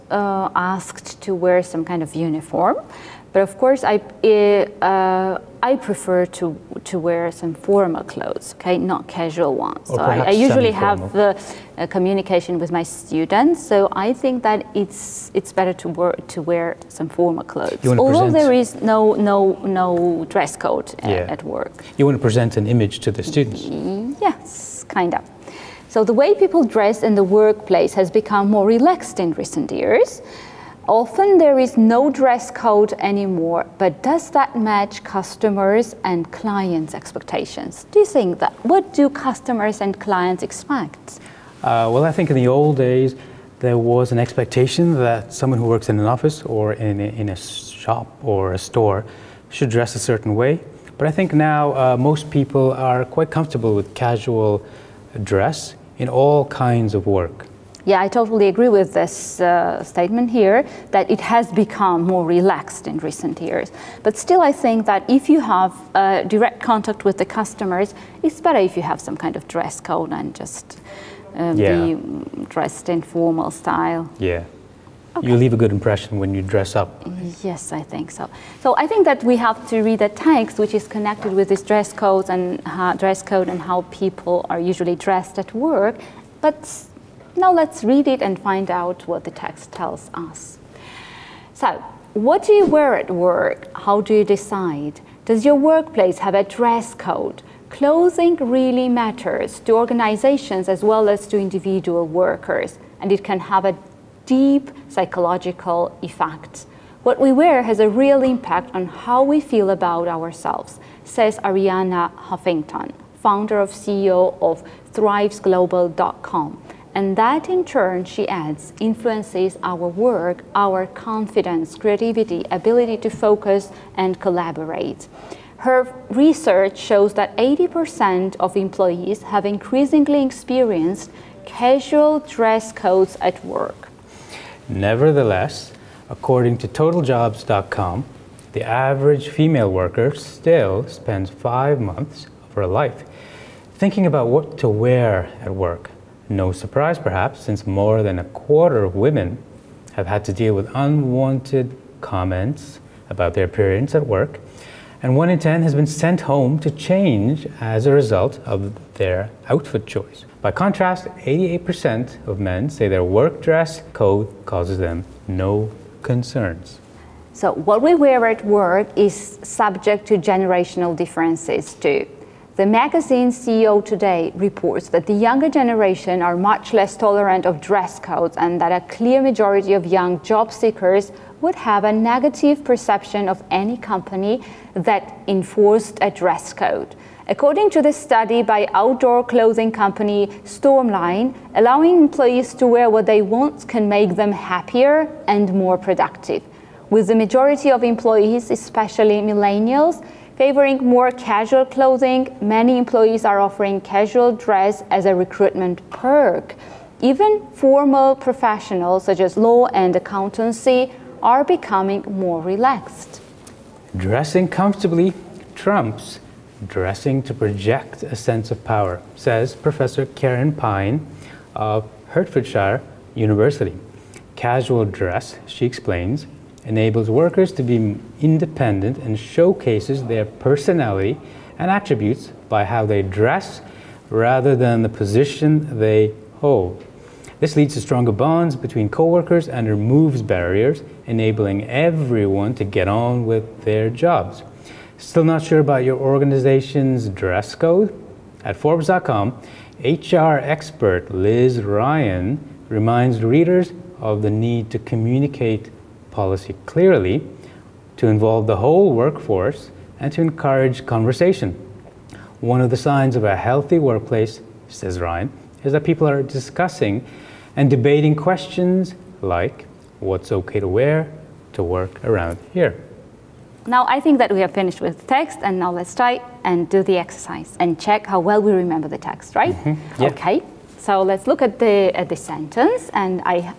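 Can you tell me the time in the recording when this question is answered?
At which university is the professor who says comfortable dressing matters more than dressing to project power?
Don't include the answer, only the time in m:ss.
3:42.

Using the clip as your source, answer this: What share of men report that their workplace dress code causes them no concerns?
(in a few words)
88%.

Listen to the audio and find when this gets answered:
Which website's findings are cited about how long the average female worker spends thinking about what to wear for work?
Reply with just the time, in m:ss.
2:16.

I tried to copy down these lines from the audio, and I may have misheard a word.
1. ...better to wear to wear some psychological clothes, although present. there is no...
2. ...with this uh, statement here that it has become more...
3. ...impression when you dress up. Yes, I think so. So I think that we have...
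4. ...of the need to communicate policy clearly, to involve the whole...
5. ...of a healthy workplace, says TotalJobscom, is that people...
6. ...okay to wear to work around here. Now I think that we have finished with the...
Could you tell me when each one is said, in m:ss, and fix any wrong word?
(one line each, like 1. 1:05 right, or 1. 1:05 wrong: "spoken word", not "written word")
1. 0:15 wrong: "formal", not "psychological"
2. 0:58 right
3. 1:15 right
4. 4:13 right
5. 4:23 wrong: "Ryan", not "TotalJobscom"
6. 4:30 right.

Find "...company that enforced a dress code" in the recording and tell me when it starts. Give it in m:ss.
3:03.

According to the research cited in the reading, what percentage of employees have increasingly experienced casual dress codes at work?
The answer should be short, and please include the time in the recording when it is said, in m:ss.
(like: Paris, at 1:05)
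80%, at 2:07.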